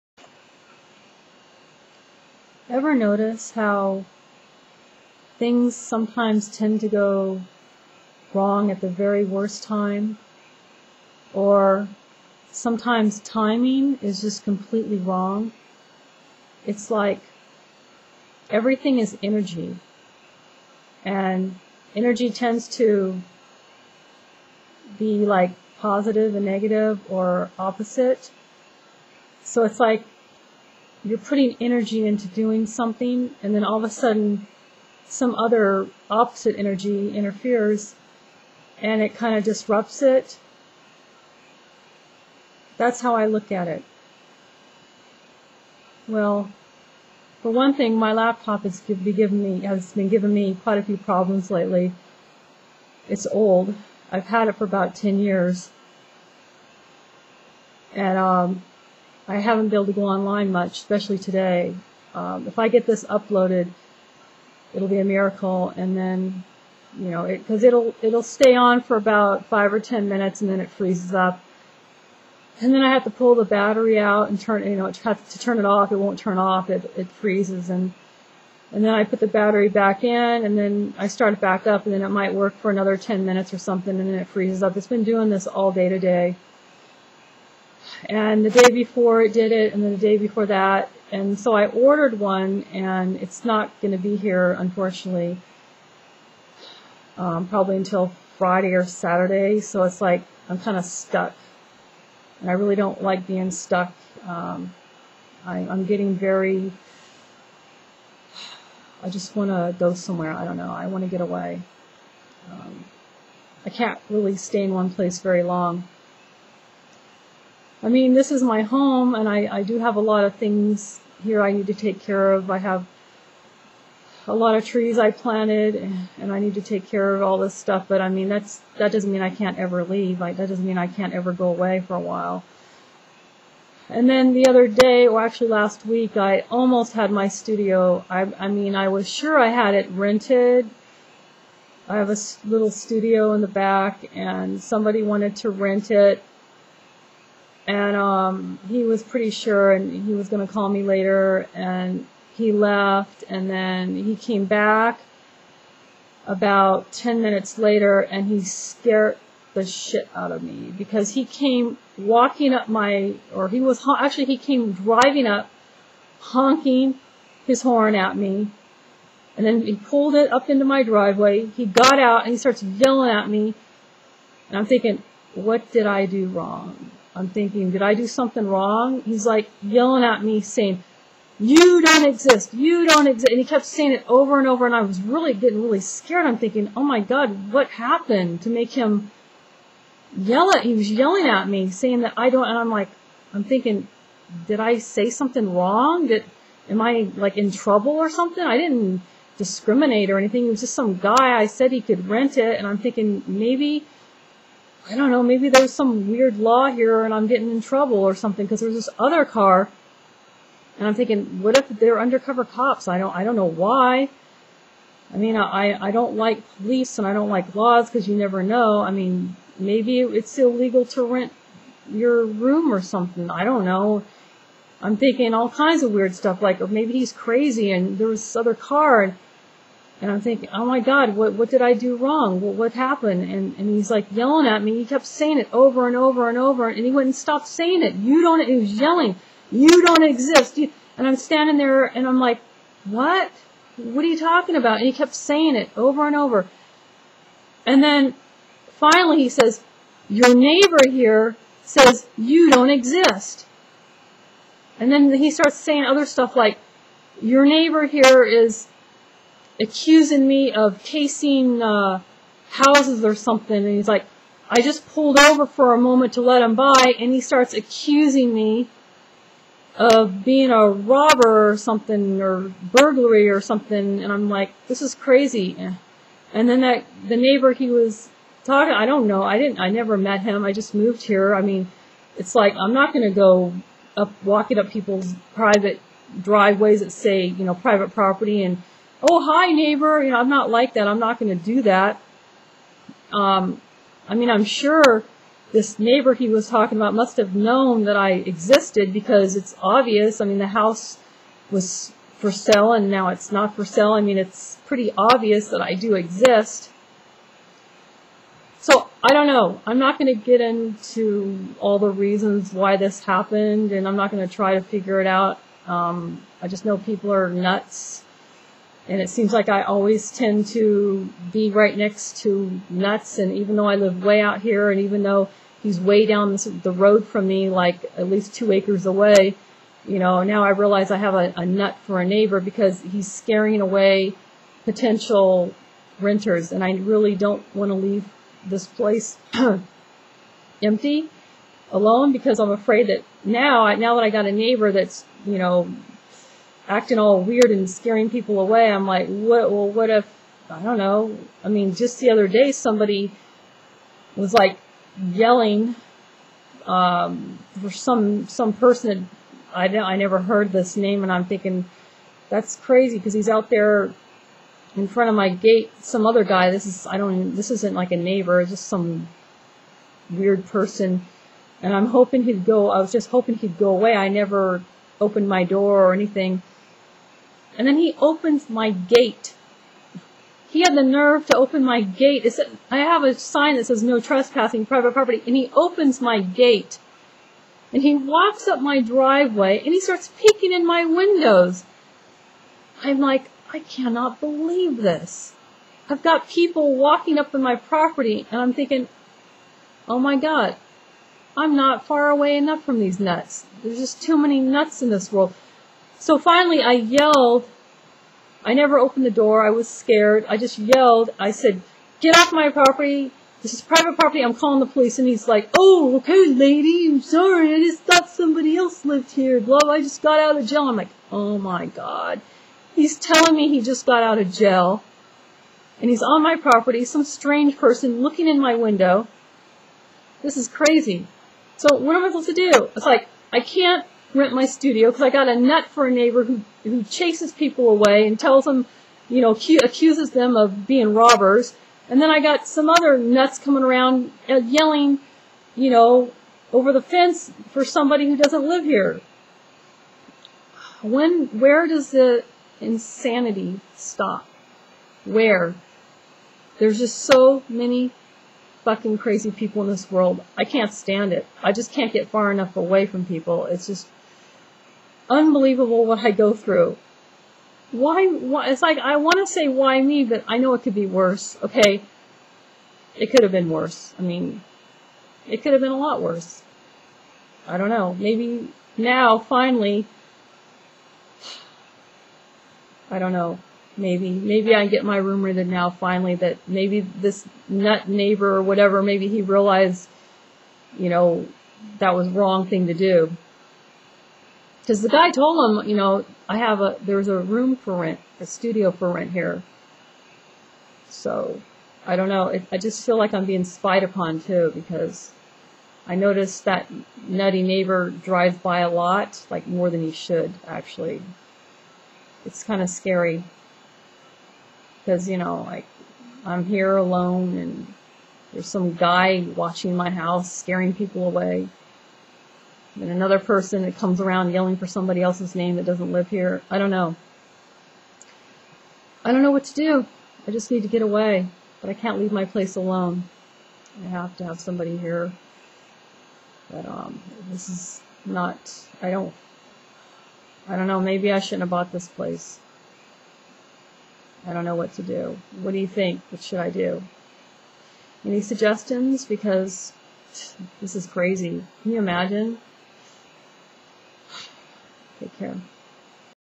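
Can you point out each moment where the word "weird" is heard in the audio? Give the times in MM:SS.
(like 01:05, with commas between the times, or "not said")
03:26, 03:45, 05:47, 06:10.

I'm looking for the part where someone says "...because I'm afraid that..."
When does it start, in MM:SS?
05:42.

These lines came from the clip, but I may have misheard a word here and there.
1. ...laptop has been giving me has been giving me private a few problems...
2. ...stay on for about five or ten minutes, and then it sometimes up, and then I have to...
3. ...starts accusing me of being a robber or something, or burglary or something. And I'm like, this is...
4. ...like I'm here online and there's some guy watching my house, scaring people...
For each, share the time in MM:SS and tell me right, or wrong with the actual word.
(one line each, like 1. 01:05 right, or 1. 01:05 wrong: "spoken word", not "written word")
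1. 00:48 wrong: "quite", not "private"
2. 01:08 wrong: "freezes", not "sometimes"
3. 04:27 right
4. 08:35 wrong: "alone", not "online".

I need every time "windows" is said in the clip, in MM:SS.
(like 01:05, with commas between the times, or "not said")
06:30, 07:08.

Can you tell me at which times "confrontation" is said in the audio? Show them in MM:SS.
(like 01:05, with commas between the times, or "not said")
not said.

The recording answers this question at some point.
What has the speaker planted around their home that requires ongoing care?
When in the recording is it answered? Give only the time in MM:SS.
02:04.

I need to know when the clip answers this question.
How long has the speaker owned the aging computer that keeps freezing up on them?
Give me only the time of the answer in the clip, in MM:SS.
00:54.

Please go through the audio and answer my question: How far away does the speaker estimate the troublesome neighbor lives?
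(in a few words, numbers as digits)
Two acres.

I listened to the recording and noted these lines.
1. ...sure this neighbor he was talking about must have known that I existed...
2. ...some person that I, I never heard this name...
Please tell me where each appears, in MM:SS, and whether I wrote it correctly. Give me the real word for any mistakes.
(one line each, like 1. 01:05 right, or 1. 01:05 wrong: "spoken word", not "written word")
1. 04:54 right
2. 05:58 right.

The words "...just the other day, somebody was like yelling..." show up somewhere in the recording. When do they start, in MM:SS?
05:51.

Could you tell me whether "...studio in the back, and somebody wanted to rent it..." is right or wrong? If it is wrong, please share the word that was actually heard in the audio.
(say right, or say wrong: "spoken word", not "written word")
right.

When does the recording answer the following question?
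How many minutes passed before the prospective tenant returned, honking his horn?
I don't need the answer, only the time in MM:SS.
02:36.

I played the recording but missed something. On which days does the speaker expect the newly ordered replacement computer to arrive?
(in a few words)
Friday or Saturday.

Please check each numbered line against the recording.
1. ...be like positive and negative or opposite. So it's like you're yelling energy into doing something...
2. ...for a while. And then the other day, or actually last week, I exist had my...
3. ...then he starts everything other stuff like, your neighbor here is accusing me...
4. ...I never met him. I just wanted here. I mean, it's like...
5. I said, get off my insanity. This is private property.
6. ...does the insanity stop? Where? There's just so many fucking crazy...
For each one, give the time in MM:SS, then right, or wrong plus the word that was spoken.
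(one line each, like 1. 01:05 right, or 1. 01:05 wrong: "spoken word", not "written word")
1. 00:24 wrong: "putting", not "yelling"
2. 02:11 wrong: "almost", not "exist"
3. 04:14 wrong: "saying", not "everything"
4. 04:39 wrong: "moved", not "wanted"
5. 06:51 wrong: "property", not "insanity"
6. 07:31 right.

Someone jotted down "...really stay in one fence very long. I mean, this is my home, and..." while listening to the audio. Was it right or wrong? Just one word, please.
wrong.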